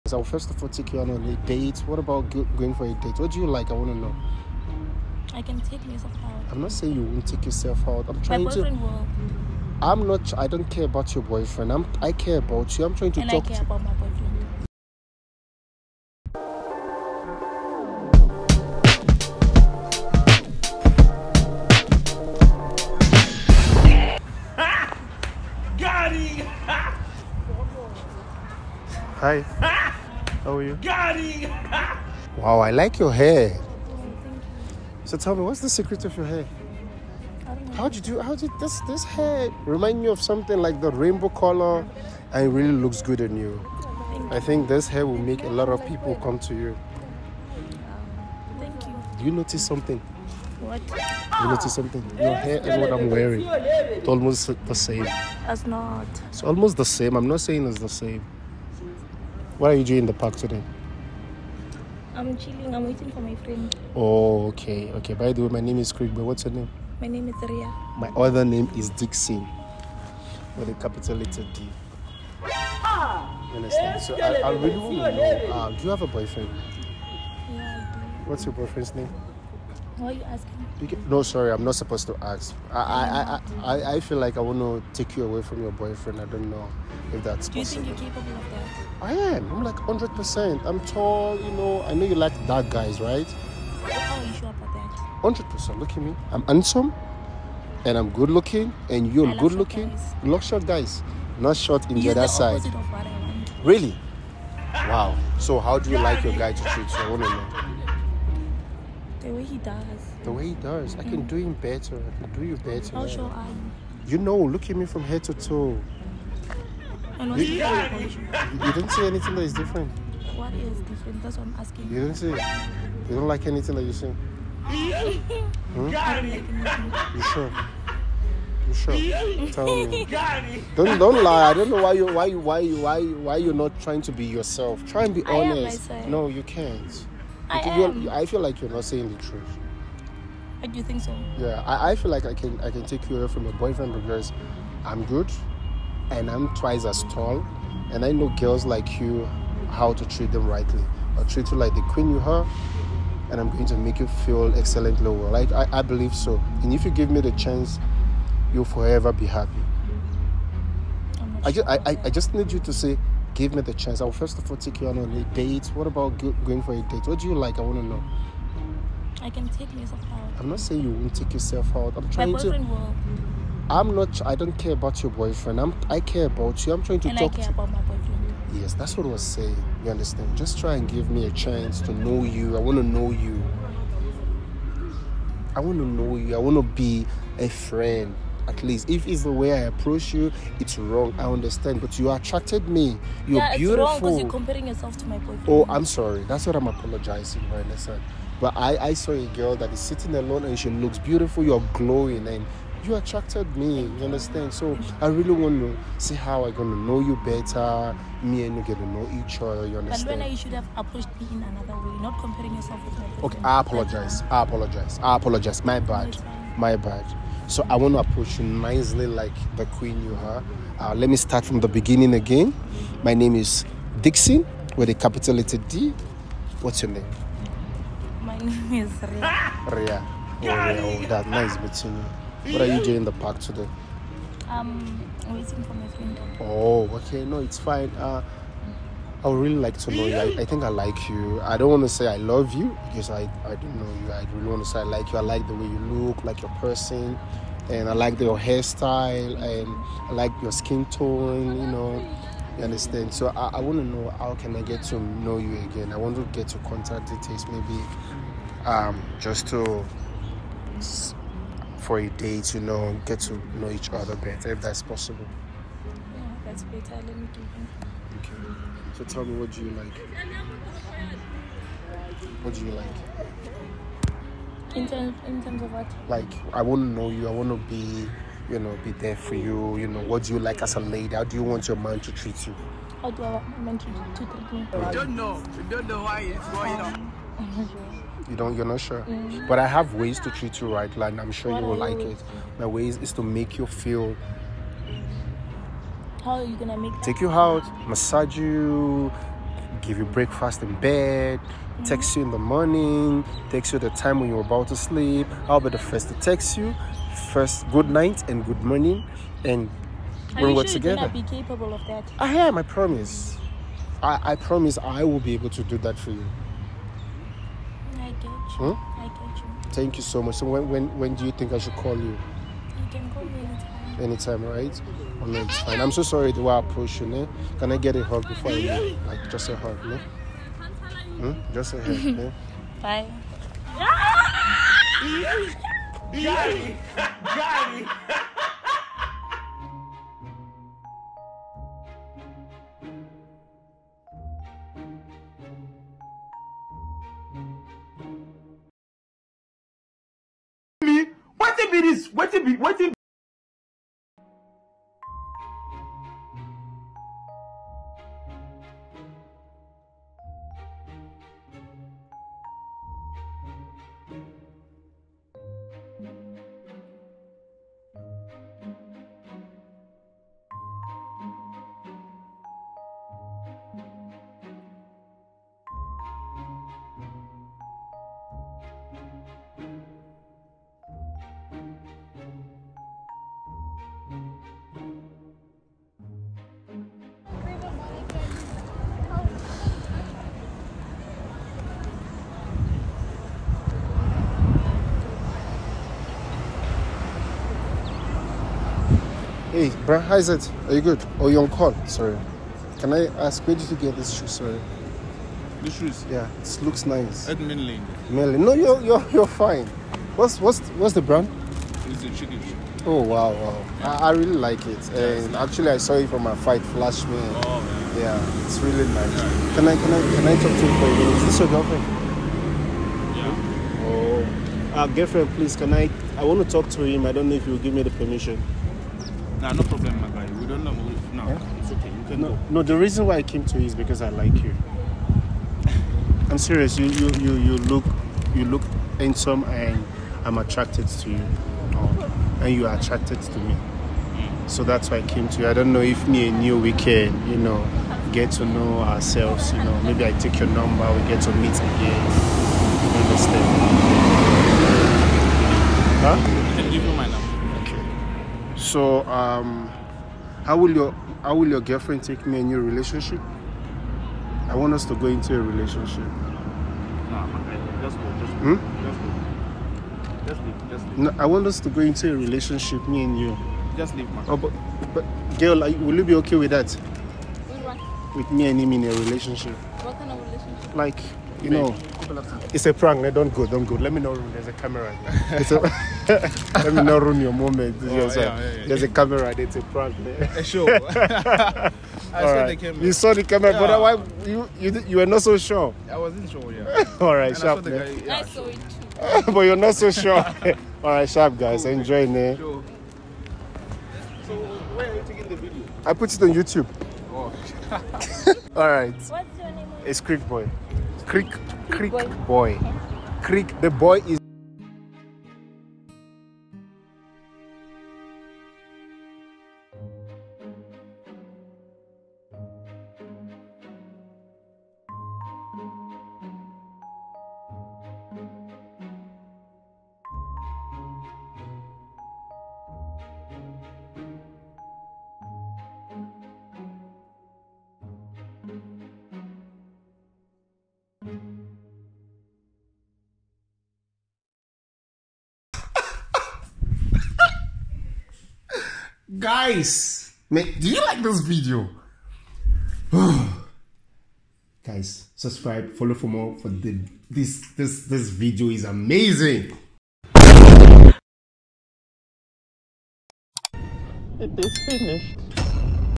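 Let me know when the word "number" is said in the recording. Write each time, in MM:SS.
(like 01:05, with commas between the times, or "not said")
07:30.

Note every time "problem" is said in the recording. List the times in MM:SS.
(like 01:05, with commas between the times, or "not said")
07:09.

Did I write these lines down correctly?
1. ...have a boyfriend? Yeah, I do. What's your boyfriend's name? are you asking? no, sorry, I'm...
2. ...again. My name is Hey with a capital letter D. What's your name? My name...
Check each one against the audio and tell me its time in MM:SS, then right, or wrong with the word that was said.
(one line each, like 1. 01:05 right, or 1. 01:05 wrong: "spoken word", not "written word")
1. 01:15 right
2. 03:42 wrong: "Dixon", not "Hey".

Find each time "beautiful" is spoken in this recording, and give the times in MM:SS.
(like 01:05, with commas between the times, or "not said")
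03:13, 03:20.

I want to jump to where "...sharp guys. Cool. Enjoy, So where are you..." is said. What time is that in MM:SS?
08:21.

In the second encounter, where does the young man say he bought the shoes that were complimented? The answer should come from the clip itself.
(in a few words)
Mainland.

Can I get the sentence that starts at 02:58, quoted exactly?
Yes, that's what I was saying.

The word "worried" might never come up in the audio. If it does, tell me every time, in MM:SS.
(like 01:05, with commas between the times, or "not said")
not said.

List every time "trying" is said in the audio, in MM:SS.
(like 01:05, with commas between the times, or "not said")
00:08, 00:12, 02:13, 02:52, 02:56.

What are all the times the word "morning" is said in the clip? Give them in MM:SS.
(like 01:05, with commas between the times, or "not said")
05:02, 05:08.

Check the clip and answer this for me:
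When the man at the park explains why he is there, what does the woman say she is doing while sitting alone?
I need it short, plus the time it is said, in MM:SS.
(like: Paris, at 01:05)
Chilling, at 01:02.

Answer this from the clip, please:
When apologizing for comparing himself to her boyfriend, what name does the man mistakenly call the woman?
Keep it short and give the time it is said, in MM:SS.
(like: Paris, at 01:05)
Vanessa, at 03:17.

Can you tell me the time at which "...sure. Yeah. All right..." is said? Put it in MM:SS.
08:16.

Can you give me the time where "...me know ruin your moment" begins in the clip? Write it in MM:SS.
08:06.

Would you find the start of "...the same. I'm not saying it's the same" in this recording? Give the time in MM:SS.
00:56.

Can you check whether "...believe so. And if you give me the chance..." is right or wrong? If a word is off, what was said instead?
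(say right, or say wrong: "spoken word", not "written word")
right.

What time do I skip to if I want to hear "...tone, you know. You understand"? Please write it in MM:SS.
04:10.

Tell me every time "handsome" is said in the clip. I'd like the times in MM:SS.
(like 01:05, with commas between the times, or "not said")
01:36, 07:18.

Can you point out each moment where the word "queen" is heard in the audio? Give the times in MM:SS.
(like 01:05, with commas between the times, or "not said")
02:31, 03:39.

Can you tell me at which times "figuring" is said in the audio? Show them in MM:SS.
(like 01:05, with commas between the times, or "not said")
not said.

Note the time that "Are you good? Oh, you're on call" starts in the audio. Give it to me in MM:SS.
06:40.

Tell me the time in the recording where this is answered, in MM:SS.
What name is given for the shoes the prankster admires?
06:52.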